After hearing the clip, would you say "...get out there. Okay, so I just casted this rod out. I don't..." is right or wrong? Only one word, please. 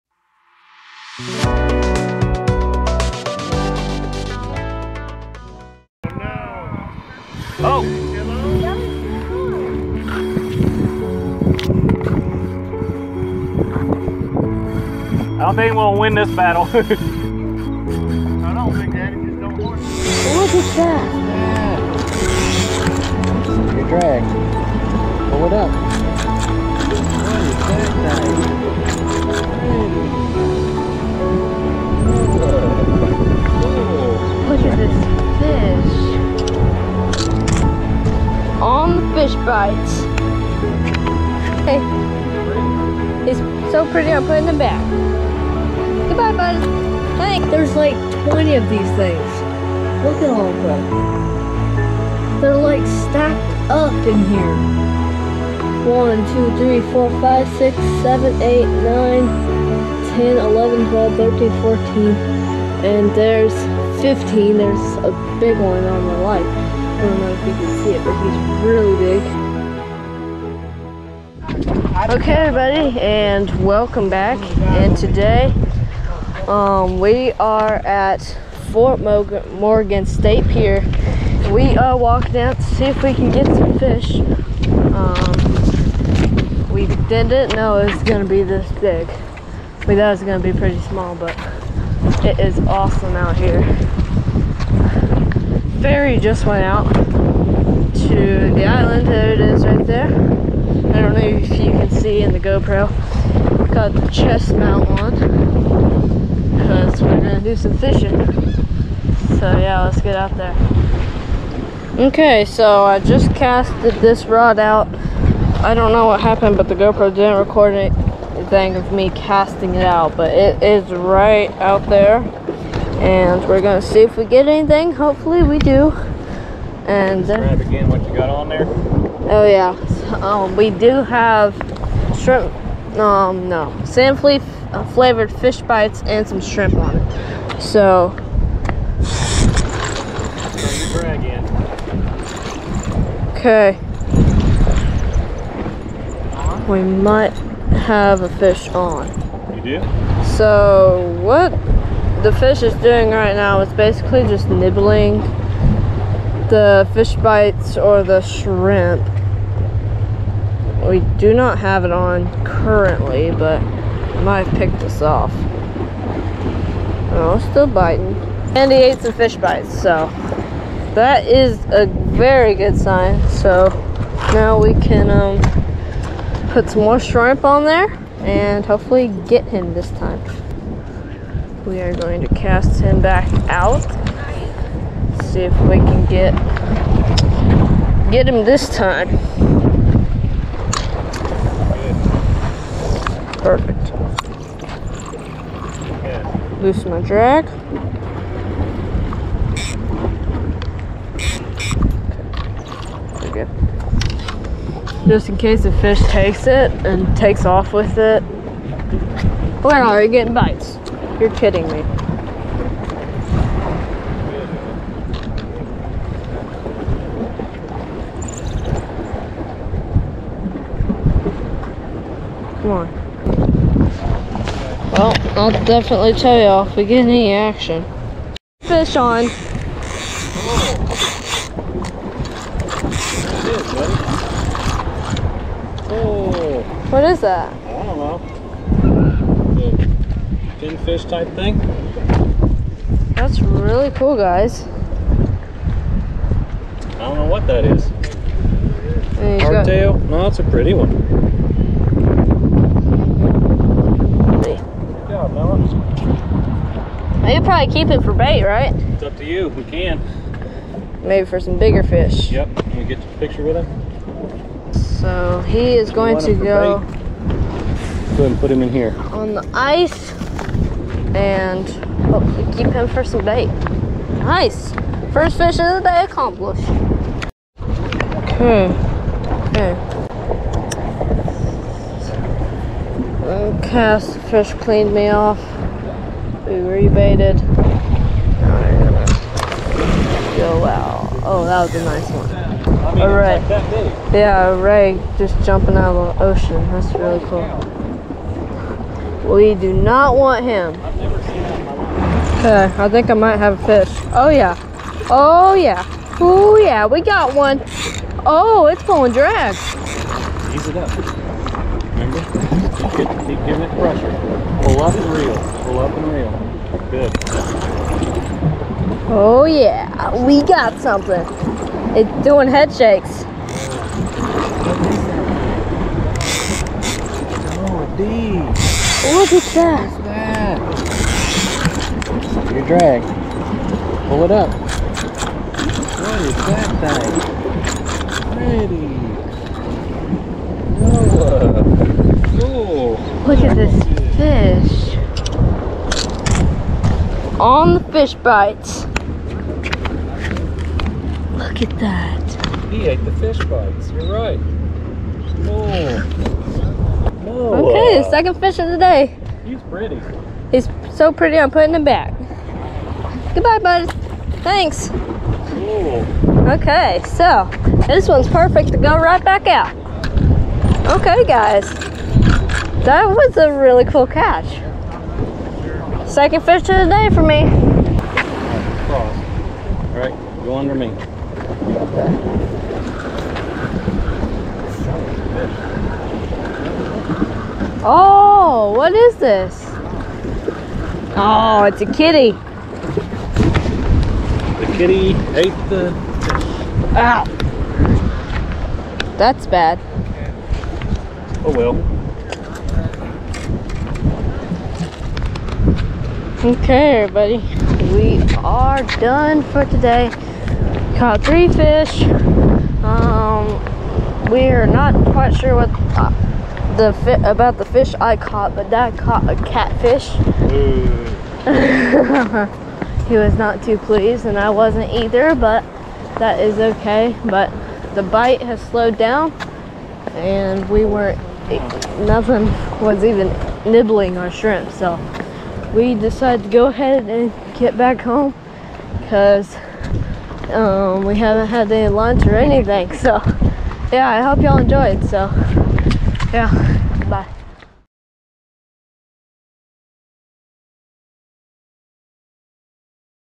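right.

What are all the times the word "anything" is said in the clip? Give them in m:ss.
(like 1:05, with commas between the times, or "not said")
1:57, 2:04, 7:22.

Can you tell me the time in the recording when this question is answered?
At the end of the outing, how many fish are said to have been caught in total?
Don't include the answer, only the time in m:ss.
6:51.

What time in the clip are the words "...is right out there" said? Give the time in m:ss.
2:00.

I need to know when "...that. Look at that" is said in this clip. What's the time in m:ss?
5:29.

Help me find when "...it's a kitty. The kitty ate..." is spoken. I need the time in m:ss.
6:31.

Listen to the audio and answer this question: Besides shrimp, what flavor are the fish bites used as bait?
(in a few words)
sand flea.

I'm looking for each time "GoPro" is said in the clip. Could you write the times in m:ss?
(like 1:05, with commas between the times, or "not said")
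1:42, 1:56.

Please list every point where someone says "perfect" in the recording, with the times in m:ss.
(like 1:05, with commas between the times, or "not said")
3:13, 6:08.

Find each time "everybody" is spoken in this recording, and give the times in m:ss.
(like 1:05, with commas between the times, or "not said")
1:12, 6:47.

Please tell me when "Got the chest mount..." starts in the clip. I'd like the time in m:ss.
1:43.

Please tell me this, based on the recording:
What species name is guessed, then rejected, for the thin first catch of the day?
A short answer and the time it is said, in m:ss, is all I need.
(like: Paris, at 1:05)
Hardtail, at 4:09.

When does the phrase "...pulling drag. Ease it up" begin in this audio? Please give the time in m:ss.
5:08.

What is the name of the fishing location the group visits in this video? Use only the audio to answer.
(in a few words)
Fort Morgan State Pier.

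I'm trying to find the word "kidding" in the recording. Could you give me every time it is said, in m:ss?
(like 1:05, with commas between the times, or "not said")
3:31.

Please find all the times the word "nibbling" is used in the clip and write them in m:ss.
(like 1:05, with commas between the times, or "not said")
2:34, 7:13.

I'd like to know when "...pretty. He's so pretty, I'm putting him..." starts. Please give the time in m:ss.
5:59.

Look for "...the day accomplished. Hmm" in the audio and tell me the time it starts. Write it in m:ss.
4:35.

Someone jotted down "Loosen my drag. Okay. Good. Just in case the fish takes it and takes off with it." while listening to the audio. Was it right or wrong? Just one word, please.
right.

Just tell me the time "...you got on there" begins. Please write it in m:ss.
2:08.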